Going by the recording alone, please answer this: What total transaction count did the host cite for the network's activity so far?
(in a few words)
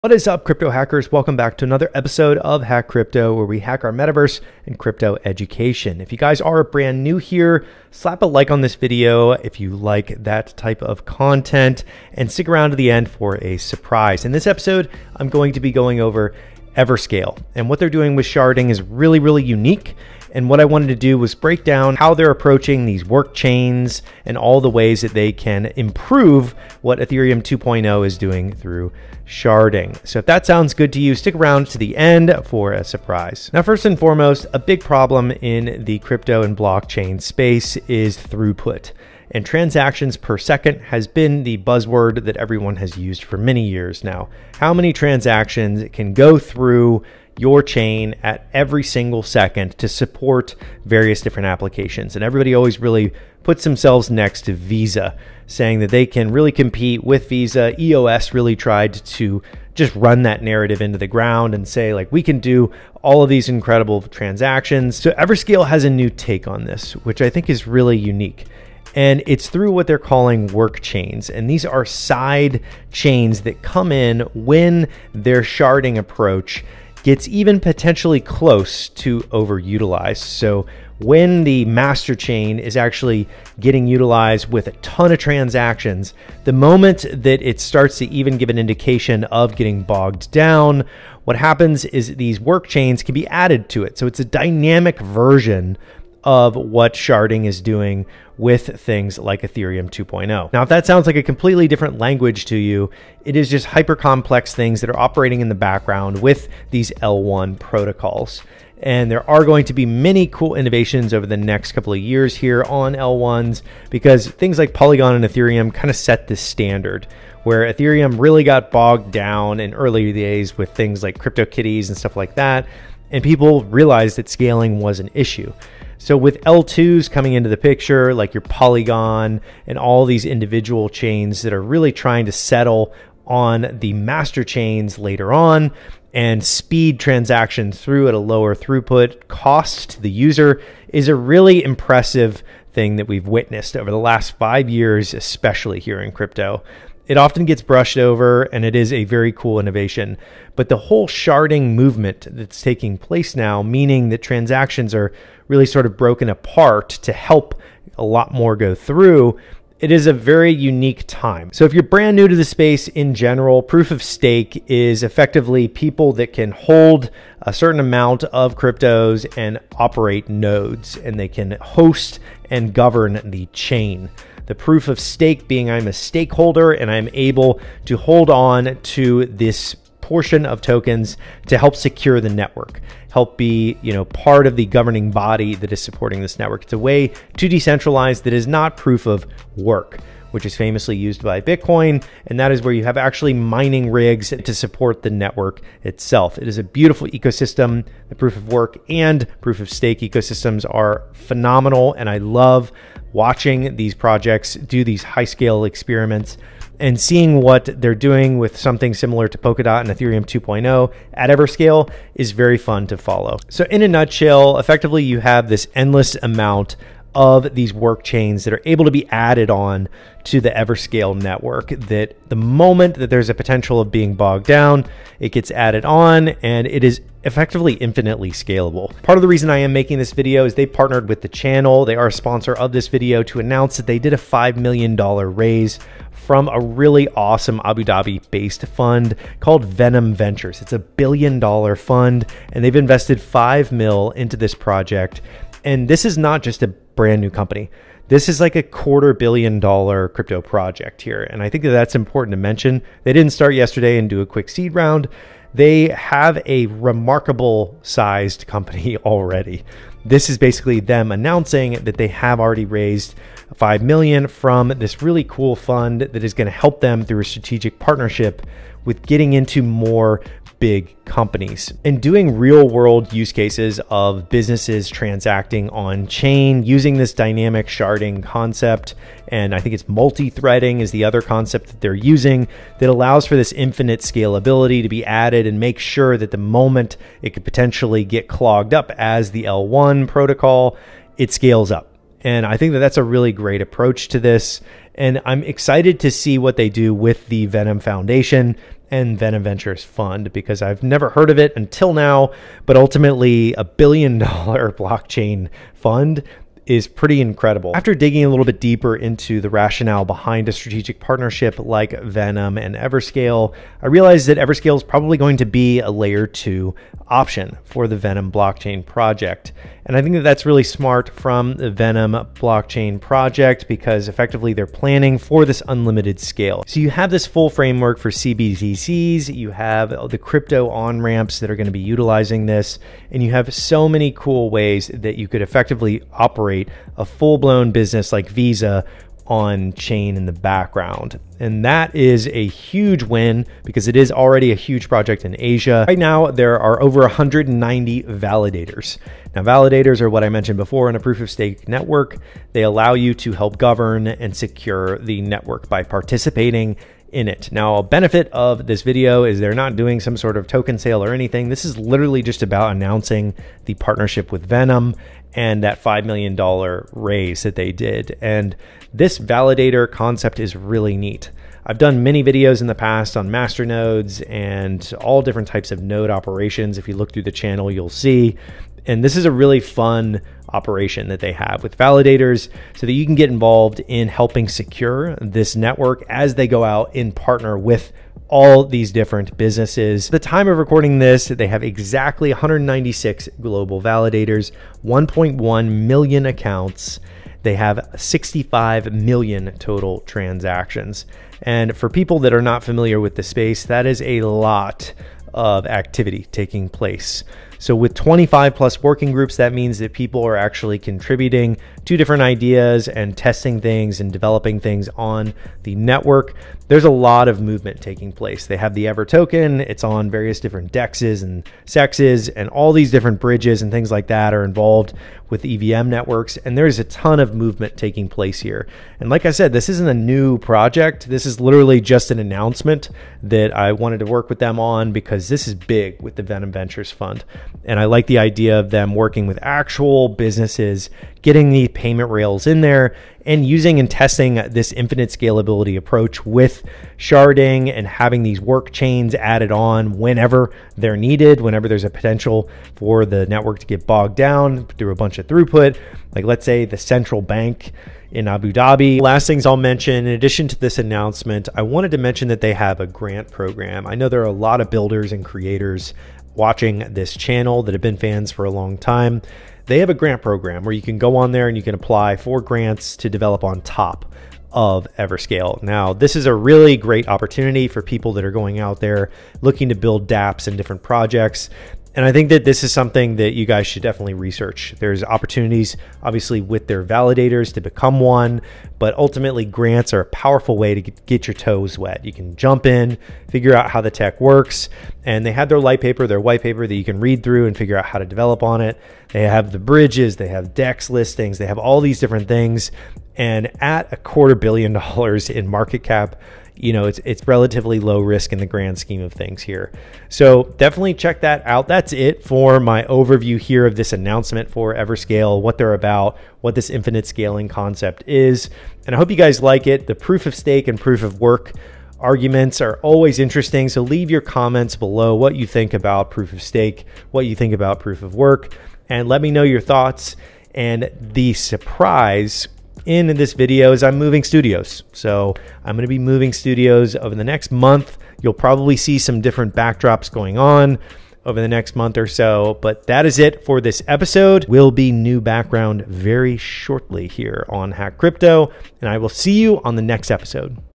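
65 million.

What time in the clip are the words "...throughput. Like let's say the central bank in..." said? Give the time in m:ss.
7:35.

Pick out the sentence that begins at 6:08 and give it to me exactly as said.
And this validator concept is really neat.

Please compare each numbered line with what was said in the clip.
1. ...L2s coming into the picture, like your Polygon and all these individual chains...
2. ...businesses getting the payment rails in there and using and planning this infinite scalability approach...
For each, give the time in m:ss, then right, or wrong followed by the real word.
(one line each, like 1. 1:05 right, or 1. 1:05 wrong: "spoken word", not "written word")
1. 2:06 right
2. 7:20 wrong: "testing", not "planning".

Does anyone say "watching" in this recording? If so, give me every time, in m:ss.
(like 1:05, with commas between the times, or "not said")
3:23, 7:46.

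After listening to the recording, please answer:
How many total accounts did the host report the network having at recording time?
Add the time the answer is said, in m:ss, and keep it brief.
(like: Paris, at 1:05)
1.1 million, at 6:34.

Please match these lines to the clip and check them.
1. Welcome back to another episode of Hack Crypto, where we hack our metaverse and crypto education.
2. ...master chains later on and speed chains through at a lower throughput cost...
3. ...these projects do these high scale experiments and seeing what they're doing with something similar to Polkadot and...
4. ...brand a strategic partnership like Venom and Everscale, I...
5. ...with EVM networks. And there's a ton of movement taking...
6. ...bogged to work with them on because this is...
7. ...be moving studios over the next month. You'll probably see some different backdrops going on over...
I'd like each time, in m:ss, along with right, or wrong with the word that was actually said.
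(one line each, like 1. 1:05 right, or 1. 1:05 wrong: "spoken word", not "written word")
1. 0:01 right
2. 2:13 wrong: "transactions", not "chains"
3. 3:23 right
4. 5:10 wrong: "behind", not "brand"
5. 7:05 right
6. 7:13 wrong: "wanted", not "bogged"
7. 8:55 right.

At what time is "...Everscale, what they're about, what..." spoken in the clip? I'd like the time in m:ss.
8:34.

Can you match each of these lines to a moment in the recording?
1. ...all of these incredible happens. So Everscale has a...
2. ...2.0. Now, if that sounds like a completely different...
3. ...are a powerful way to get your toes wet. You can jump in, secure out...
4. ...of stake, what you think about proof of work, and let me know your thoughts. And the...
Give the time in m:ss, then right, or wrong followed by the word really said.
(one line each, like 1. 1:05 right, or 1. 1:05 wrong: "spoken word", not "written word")
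1. 1:03 wrong: "transactions", not "happens"
2. 1:39 right
3. 8:09 wrong: "figure", not "secure"
4. 8:46 right.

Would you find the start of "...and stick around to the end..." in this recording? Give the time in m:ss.
0:12.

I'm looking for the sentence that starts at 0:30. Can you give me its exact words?
So if that sounds good to you, stick around to the end for a surprise.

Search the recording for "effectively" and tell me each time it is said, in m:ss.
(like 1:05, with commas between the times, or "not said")
2:45, 3:34, 3:47, 5:24, 5:35.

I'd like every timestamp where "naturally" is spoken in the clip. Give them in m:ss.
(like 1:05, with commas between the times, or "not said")
not said.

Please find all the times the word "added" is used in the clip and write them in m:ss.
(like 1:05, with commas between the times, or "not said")
1:33, 3:39, 3:45, 4:45, 7:29.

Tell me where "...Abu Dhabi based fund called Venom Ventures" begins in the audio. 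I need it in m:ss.
3:57.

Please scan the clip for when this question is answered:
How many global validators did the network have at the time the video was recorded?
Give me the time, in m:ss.
6:32.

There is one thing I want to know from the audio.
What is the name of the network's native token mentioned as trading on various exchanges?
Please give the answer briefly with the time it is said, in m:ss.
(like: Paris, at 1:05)
Ever, at 6:58.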